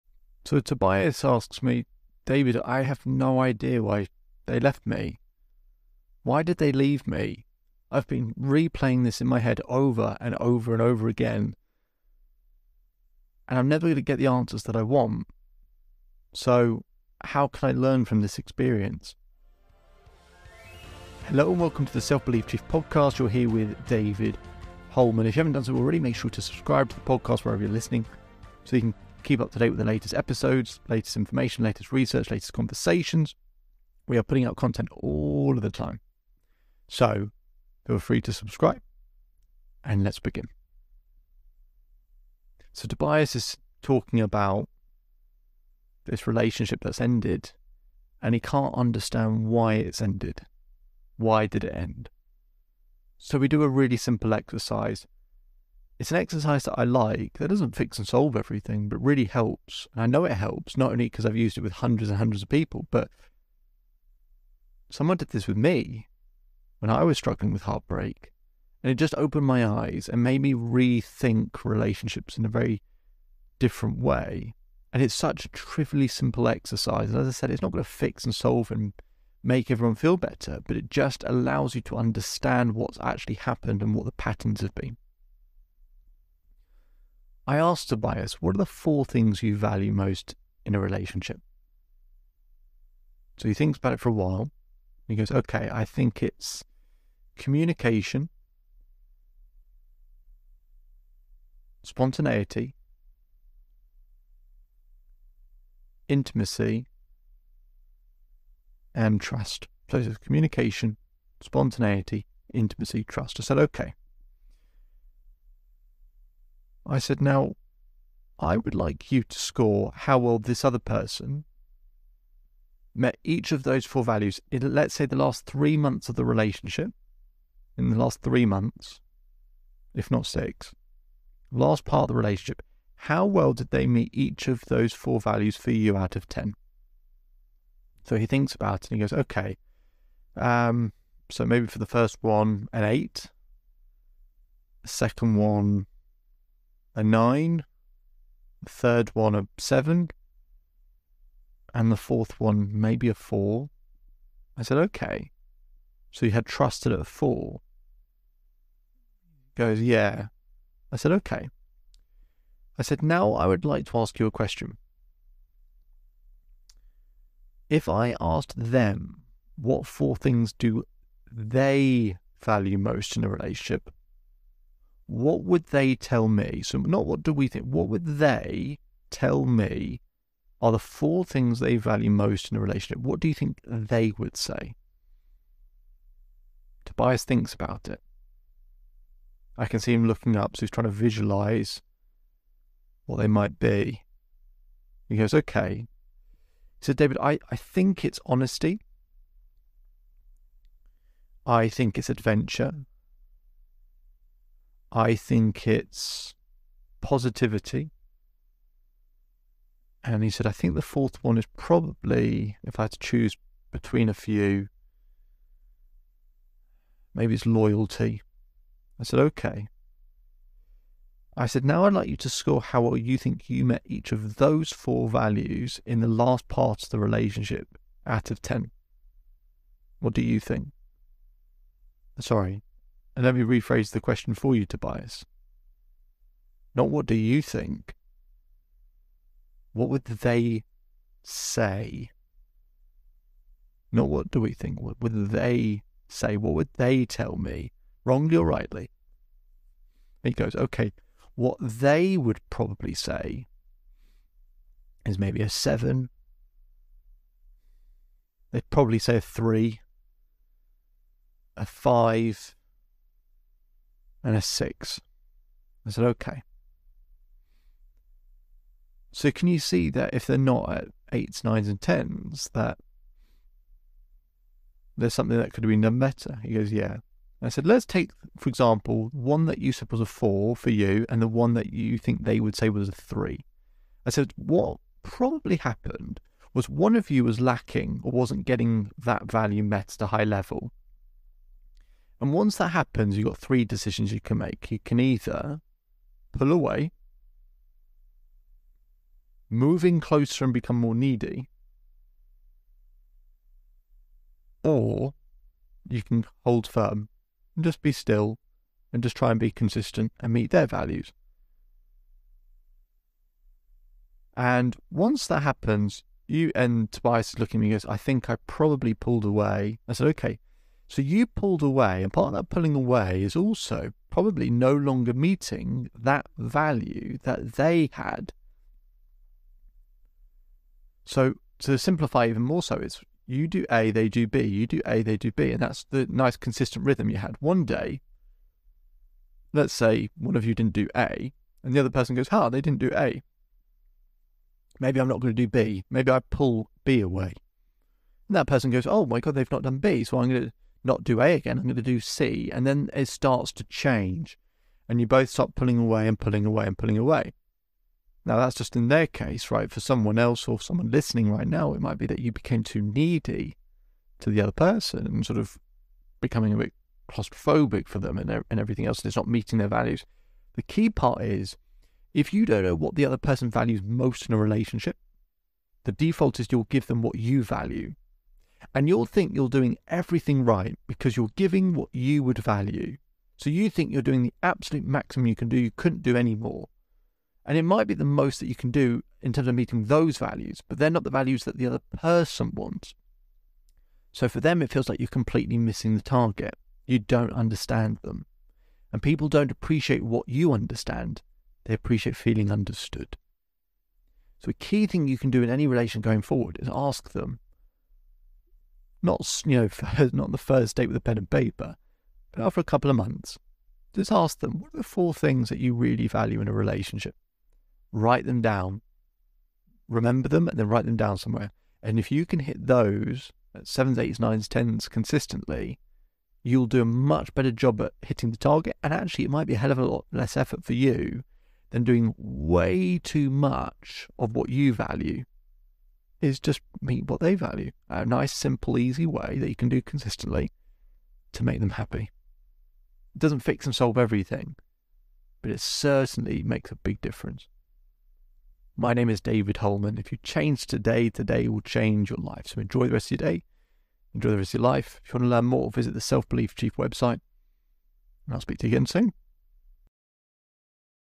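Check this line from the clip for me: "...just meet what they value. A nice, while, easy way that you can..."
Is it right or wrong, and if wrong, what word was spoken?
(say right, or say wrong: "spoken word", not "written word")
wrong: "simple", not "while".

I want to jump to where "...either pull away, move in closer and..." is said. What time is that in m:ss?
4:54.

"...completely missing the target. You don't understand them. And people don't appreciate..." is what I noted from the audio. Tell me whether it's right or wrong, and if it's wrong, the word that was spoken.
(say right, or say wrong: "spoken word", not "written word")
right.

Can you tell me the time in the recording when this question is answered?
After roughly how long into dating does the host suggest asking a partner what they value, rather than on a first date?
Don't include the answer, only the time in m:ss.
6:52.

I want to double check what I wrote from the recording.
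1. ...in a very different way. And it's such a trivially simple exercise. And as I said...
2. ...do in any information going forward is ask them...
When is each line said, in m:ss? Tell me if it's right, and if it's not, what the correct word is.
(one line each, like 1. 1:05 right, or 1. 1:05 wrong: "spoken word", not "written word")
1. 1:12 right
2. 6:45 wrong: "relation", not "information".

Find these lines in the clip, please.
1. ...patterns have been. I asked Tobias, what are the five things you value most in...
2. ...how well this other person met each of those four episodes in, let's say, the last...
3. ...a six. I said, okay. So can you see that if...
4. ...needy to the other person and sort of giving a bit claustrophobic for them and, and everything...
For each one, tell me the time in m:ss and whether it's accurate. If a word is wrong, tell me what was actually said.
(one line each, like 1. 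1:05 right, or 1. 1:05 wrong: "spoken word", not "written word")
1. 1:24 wrong: "four", not "five"
2. 1:59 wrong: "values", not "episodes"
3. 4:24 right
4. 6:02 wrong: "becoming", not "giving".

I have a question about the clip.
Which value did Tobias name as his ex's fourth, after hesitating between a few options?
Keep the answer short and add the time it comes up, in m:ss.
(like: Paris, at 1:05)
Loyalty, at 3:37.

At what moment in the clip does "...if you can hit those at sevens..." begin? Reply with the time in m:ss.
7:01.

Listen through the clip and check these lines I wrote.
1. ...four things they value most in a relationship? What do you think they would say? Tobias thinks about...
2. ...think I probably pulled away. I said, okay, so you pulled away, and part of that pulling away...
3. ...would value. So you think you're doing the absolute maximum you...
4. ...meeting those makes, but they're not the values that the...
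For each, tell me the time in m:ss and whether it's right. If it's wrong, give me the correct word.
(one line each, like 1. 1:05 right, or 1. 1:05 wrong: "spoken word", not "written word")
1. 3:00 right
2. 5:17 right
3. 6:22 right
4. 6:29 wrong: "values", not "makes".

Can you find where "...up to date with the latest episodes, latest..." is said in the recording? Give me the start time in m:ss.
0:29.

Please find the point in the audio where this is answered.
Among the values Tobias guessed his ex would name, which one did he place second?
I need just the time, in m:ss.
3:22.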